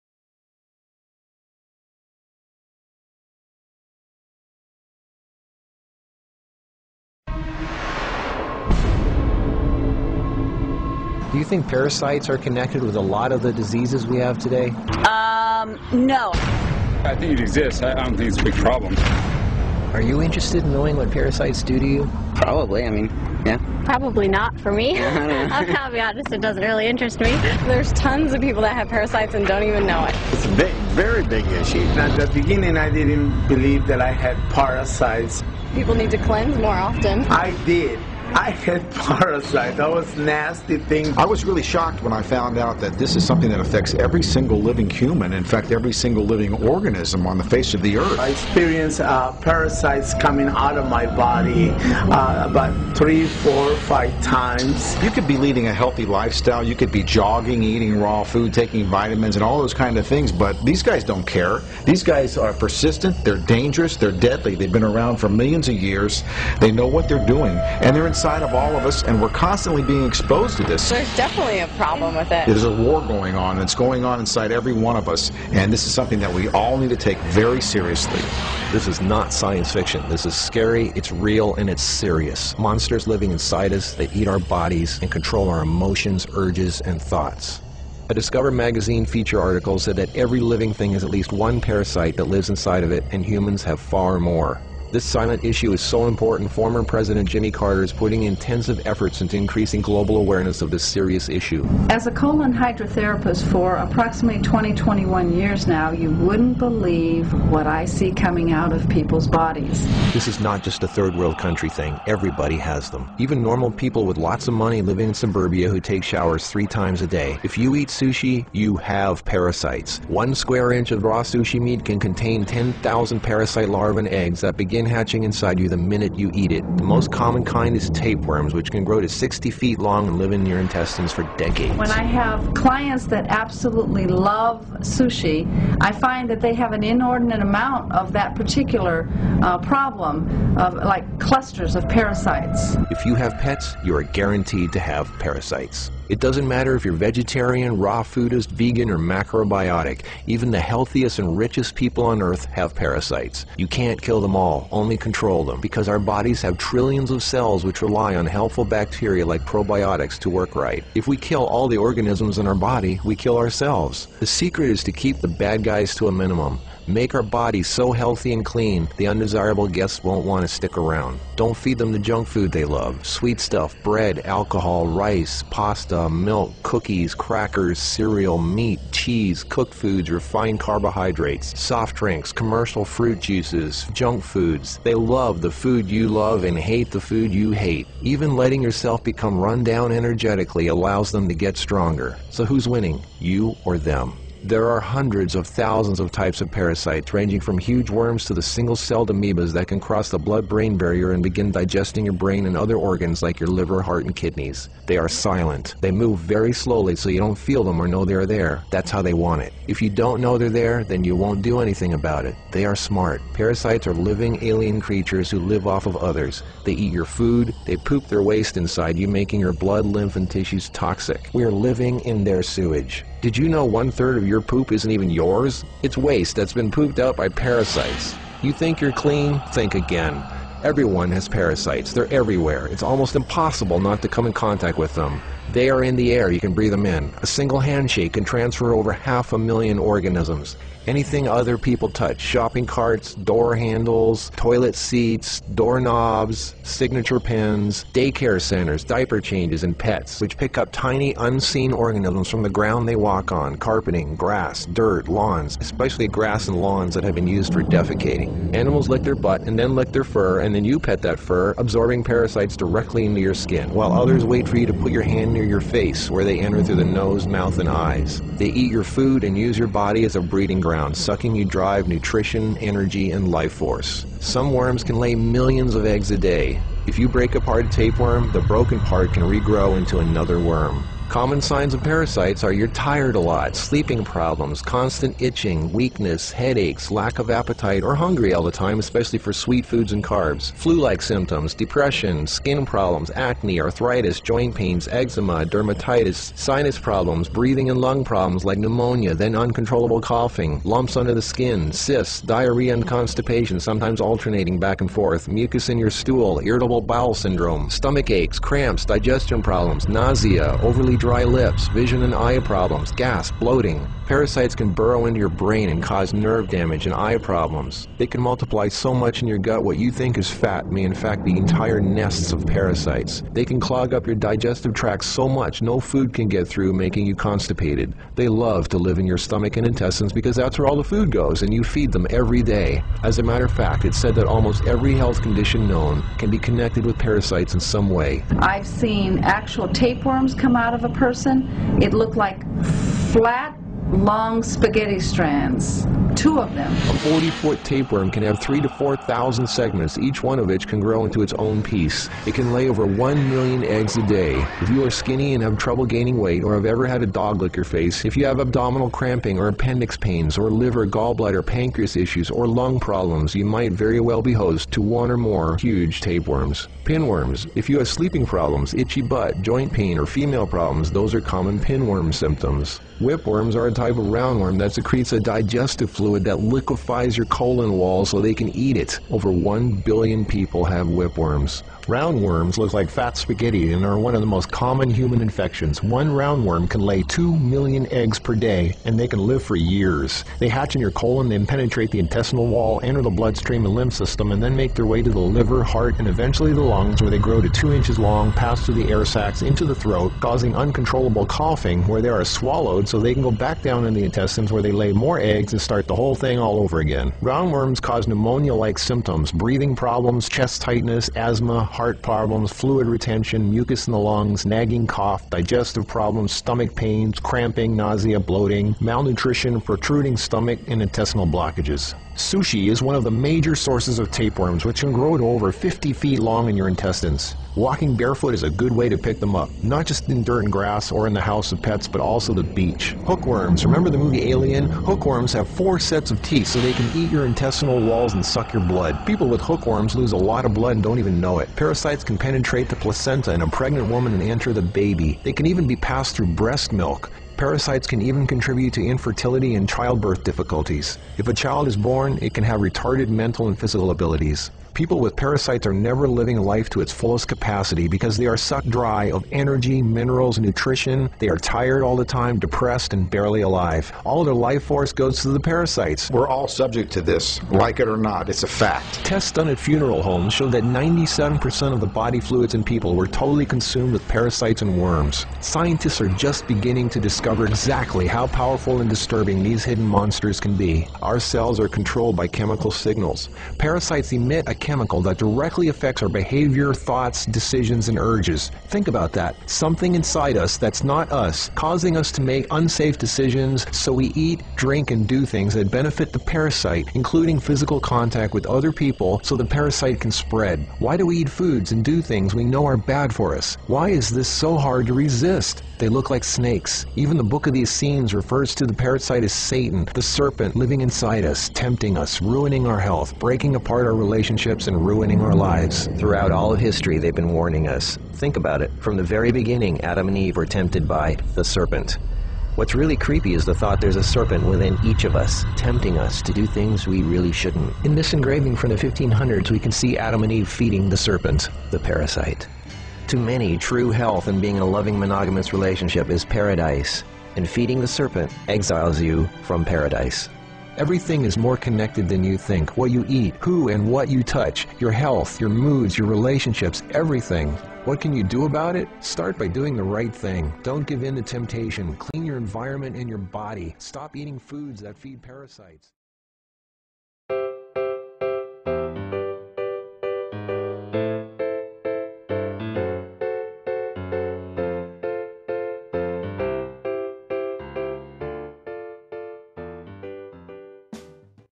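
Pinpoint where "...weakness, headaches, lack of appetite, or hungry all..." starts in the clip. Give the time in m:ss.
4:45.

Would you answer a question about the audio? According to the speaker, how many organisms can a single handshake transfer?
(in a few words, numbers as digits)
over half a million.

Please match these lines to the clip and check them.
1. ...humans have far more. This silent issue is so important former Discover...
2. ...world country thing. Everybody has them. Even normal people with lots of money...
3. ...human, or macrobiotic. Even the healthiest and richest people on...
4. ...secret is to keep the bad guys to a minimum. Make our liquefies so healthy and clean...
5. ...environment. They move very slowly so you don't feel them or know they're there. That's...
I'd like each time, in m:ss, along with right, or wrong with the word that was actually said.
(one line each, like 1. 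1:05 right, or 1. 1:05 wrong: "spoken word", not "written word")
1. 1:33 wrong: "President", not "Discover"
2. 1:51 right
3. 2:28 wrong: "vegan", not "human"
4. 2:44 wrong: "bodies", not "liquefies"
5. 3:25 wrong: "silent", not "environment".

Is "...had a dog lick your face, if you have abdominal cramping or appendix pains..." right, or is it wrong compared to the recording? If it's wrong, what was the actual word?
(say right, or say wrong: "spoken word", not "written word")
right.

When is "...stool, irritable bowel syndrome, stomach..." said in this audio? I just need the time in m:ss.
5:05.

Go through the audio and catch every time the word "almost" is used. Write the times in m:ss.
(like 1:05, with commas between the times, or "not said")
3:52, 5:34.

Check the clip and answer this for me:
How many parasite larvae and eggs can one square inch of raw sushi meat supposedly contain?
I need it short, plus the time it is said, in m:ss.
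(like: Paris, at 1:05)
10,000, at 2:02.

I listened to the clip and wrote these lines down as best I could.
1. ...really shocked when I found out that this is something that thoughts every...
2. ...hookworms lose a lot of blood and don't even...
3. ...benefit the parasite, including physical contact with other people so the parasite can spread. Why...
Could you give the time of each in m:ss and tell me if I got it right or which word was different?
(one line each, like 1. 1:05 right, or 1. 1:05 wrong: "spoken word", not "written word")
1. 0:41 wrong: "affects", not "thoughts"
2. 7:19 right
3. 8:15 right.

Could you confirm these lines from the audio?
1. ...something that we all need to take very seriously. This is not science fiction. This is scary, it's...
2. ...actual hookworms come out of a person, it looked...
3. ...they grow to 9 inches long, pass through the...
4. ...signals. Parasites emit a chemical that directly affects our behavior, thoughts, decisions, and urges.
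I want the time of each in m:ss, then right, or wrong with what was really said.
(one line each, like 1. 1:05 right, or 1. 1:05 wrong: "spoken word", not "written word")
1. 1:15 right
2. 5:39 wrong: "tapeworms", not "hookworms"
3. 6:37 wrong: "2", not "9"
4. 8:02 right.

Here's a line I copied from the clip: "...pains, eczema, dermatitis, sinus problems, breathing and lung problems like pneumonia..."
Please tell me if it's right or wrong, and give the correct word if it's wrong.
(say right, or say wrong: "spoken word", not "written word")
right.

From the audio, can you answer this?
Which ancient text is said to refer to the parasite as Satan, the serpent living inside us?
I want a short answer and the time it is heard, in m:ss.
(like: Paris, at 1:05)
Book of the Essenes, at 8:27.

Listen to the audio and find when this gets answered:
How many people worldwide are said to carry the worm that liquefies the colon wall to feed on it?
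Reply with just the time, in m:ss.
6:19.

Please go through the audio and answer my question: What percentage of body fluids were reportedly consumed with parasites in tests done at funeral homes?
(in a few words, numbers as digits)
97%.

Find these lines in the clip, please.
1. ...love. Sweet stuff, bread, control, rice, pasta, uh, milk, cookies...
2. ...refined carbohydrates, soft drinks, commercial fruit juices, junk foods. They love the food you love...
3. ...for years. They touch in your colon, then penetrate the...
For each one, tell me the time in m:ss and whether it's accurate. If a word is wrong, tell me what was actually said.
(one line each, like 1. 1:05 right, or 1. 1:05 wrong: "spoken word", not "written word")
1. 2:52 wrong: "alcohol", not "control"
2. 3:00 right
3. 6:29 wrong: "hatch", not "touch".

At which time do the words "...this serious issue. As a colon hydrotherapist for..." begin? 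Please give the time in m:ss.
1:40.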